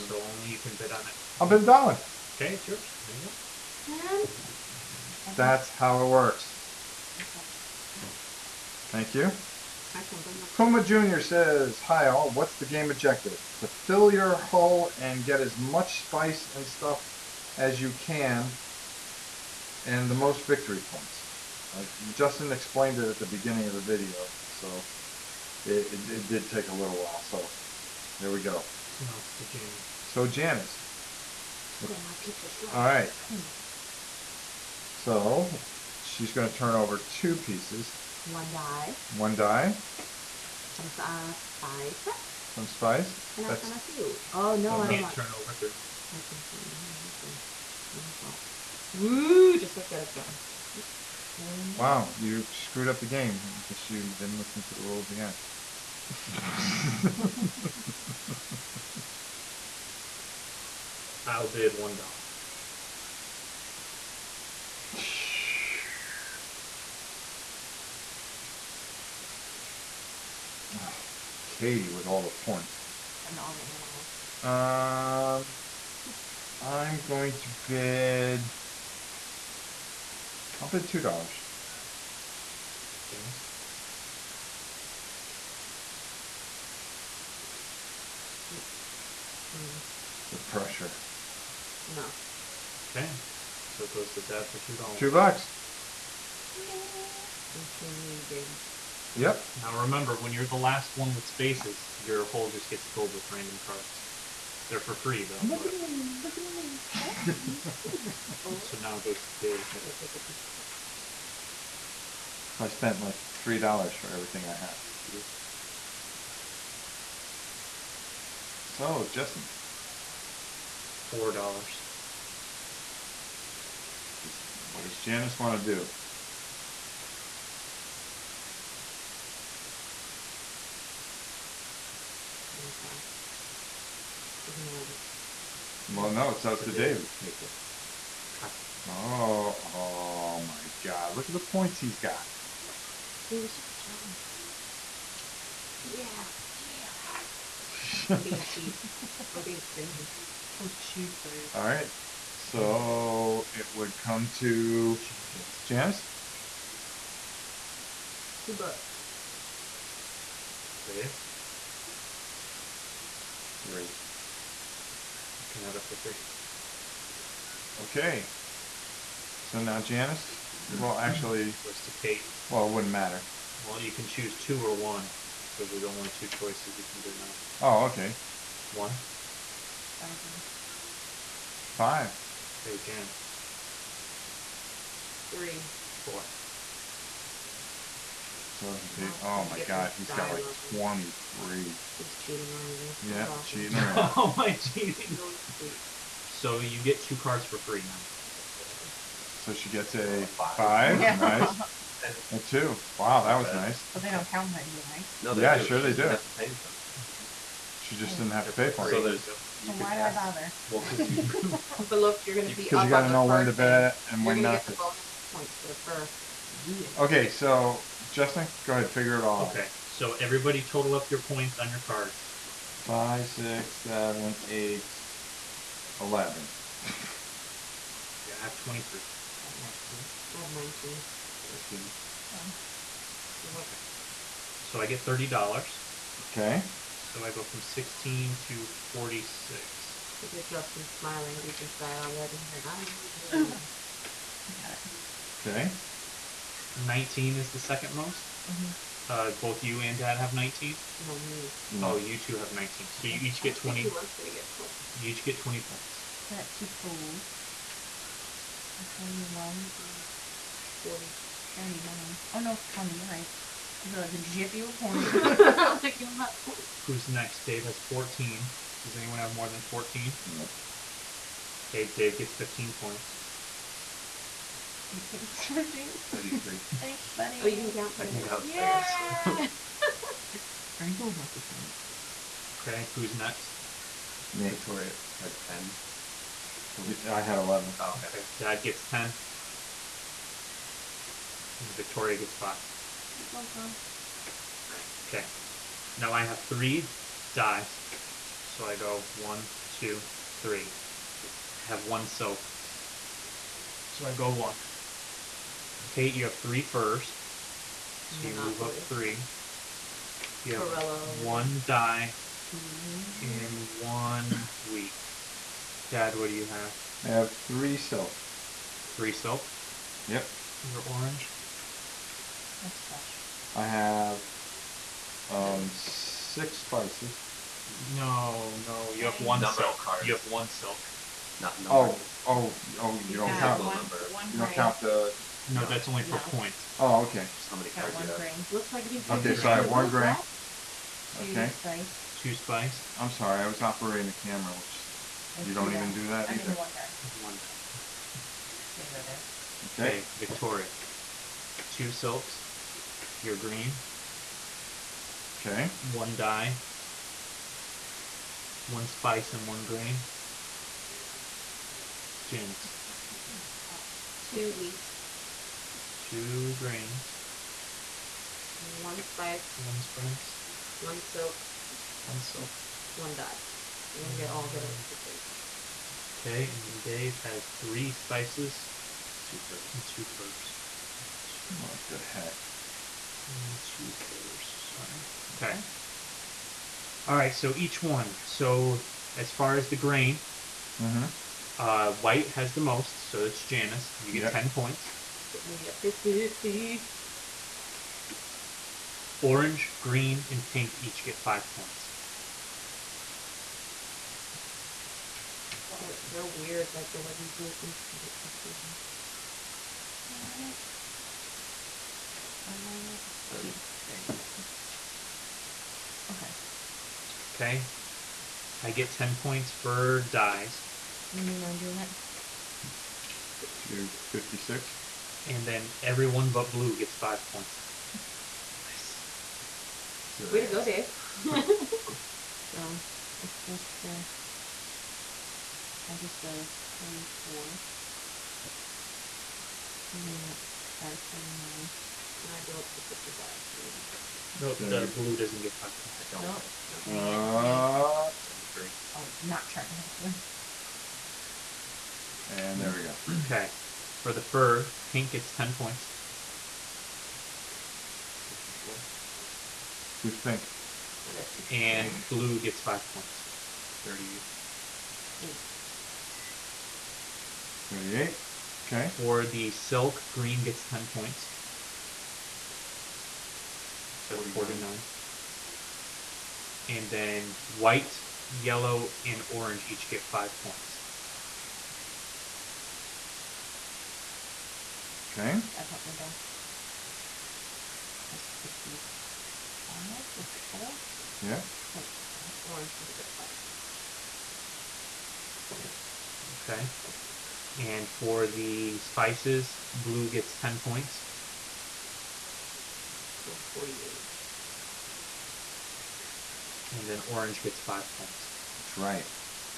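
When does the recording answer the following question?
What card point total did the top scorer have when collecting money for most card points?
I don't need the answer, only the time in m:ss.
3:48.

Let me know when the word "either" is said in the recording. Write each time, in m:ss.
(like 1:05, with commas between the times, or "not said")
5:46.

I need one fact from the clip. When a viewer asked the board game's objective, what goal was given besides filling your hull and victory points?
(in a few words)
Get as much spice.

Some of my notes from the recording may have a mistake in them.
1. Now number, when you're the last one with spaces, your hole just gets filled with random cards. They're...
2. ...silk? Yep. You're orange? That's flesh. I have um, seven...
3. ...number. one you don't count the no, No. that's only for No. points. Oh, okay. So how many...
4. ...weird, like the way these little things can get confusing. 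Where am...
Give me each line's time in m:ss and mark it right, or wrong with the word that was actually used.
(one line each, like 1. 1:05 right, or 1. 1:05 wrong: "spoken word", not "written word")
1. 1:39 wrong: "remember", not "number"
2. 5:19 wrong: "six", not "seven"
3. 5:33 right
4. 6:46 right.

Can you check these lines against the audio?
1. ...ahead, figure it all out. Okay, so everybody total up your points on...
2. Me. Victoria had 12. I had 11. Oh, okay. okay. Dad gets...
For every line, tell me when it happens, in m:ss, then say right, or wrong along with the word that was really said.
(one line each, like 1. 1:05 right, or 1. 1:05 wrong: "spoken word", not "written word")
1. 3:38 right
2. 4:44 wrong: "10", not "12".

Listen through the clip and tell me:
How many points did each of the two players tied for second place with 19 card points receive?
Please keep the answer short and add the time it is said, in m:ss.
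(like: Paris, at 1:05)
20, at 4:14.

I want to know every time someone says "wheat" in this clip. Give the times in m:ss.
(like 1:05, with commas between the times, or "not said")
5:14, 6:04.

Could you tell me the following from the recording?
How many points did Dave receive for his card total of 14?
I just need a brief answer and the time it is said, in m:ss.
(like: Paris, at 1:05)
15, at 4:31.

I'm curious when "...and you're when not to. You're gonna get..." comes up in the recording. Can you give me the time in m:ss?
3:34.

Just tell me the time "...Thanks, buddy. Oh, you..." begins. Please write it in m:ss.
4:36.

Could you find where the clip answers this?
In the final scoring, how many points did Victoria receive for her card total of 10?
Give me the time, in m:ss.
4:51.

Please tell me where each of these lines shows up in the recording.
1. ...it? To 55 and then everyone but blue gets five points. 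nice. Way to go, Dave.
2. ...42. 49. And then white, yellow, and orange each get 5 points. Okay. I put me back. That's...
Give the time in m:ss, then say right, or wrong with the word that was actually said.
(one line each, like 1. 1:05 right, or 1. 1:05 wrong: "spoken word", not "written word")
1. 7:01 wrong: "56", not "55"
2. 7:54 wrong: "49", not "42".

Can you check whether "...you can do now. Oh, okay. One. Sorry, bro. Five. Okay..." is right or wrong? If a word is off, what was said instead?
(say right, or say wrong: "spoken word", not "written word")
right.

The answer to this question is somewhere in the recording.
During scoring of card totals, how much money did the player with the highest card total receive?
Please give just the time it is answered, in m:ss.
3:55.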